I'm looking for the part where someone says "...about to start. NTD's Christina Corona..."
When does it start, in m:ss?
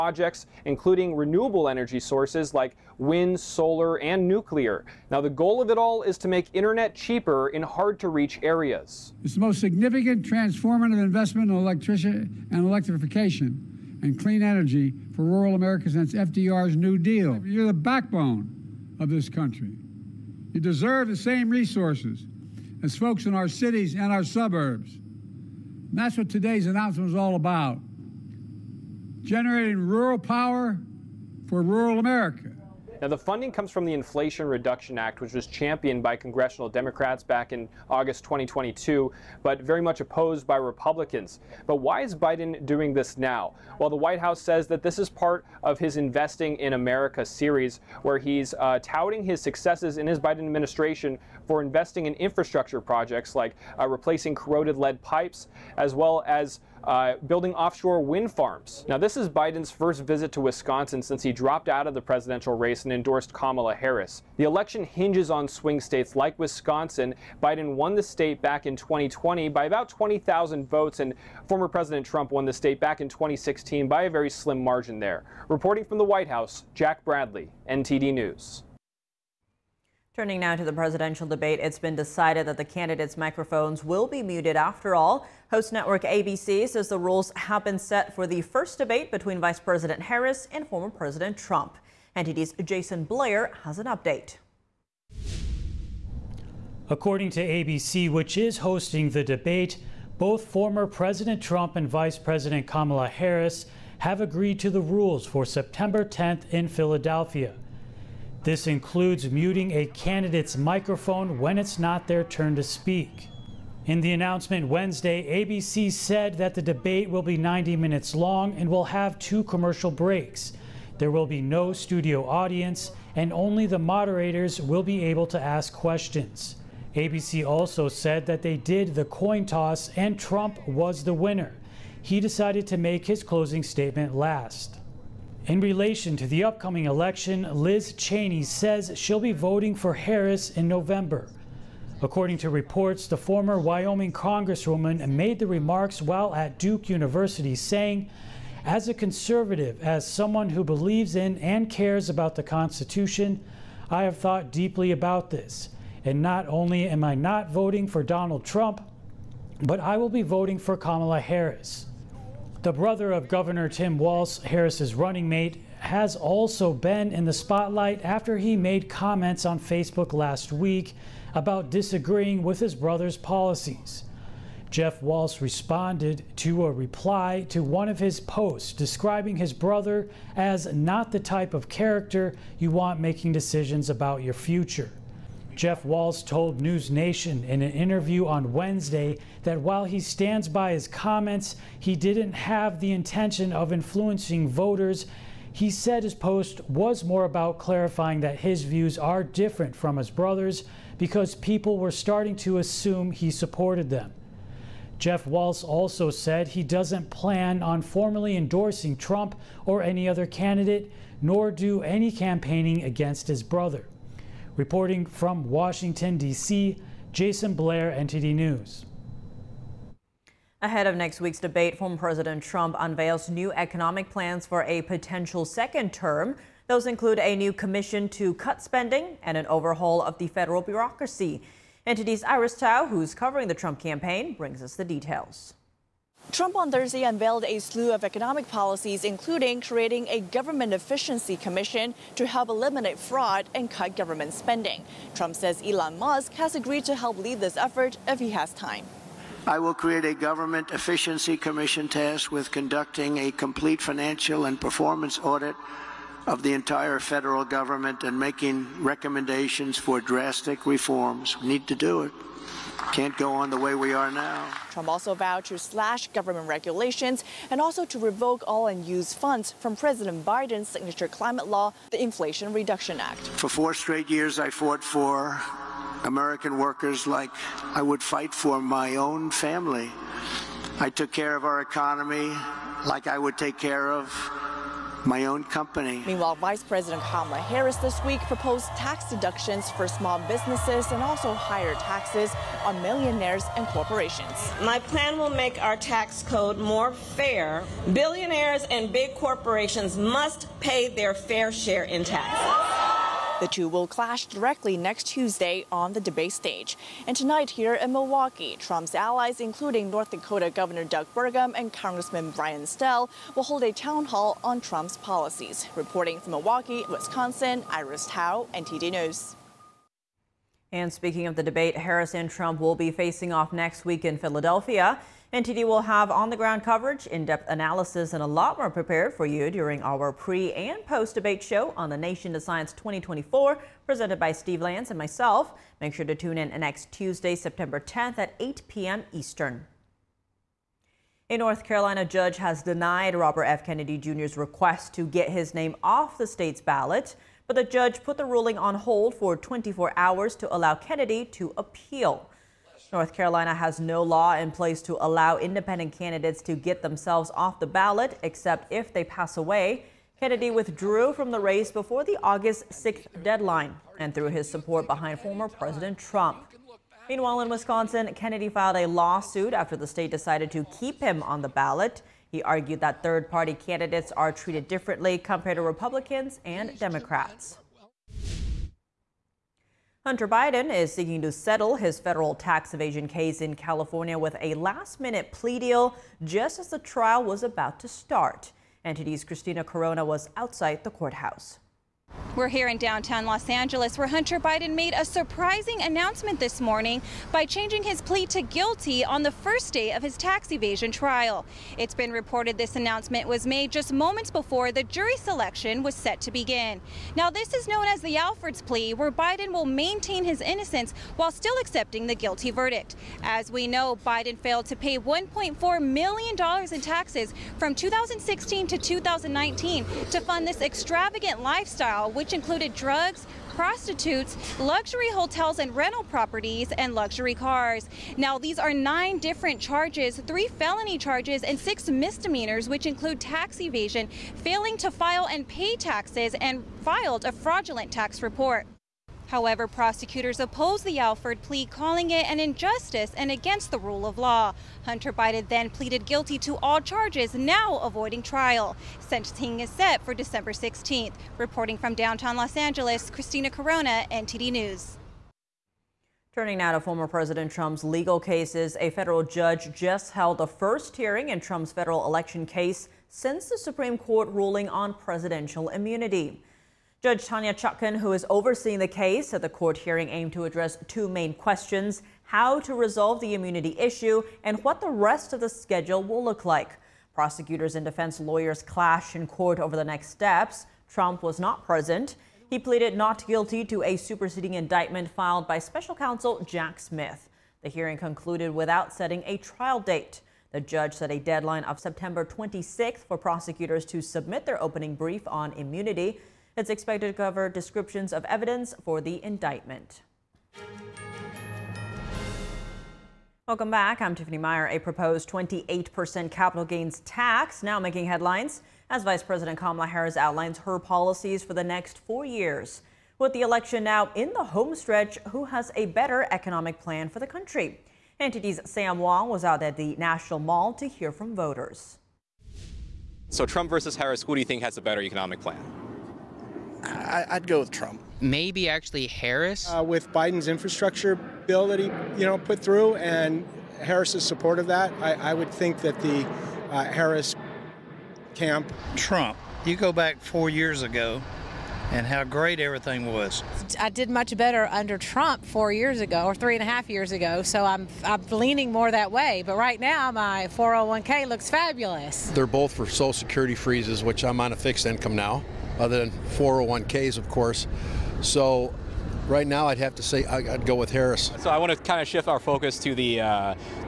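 6:27.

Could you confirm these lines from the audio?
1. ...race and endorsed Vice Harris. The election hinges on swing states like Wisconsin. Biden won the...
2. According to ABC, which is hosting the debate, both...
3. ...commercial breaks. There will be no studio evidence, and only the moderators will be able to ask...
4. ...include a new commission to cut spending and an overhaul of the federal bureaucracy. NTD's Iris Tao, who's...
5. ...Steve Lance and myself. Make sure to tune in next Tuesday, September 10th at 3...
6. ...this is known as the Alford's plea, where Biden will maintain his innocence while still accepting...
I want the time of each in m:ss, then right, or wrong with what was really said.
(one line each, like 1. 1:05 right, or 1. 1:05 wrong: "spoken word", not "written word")
1. 1:02 wrong: "Kamala", not "Vice"
2. 1:36 right
3. 1:59 wrong: "audience", not "evidence"
4. 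3:46 right
5. 5:34 wrong: "8", not "3"
6. 6:47 right.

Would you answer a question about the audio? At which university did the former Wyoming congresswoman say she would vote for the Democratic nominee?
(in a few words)
Duke University.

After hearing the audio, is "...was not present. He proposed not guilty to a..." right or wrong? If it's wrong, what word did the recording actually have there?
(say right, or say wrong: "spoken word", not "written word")
wrong: "pleaded", not "proposed".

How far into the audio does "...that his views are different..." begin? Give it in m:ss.
3:18.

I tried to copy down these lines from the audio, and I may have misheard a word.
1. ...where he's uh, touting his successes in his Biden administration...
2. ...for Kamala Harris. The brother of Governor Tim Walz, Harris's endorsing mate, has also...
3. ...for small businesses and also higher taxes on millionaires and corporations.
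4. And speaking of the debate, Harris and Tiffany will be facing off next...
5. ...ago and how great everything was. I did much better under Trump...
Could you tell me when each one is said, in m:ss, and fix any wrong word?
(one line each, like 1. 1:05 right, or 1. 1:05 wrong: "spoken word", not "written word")
1. 0:48 right
2. 2:40 wrong: "running", not "endorsing"
3. 4:49 right
4. 5:20 wrong: "Trump", not "Tiffany"
5. 9:00 right.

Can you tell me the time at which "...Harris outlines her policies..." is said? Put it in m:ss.
8:29.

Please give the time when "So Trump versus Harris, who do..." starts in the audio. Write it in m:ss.
8:43.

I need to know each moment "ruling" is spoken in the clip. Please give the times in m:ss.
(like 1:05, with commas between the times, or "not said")
5:48, 7:44.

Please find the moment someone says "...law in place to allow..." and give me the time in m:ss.
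5:54.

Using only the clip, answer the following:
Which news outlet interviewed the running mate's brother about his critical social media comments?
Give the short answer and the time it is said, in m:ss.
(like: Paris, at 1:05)
News Nation, at 3:06.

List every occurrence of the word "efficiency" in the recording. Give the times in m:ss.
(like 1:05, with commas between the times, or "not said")
4:00, 4:10.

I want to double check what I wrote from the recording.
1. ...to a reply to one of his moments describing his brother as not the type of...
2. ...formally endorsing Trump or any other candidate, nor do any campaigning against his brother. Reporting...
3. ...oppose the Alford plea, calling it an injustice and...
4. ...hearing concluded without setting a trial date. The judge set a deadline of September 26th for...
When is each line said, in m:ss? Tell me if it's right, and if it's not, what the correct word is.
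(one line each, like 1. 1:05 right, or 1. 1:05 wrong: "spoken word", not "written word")
1. 2:56 wrong: "posts", not "moments"
2. 3:27 right
3. 7:20 right
4. 8:07 right.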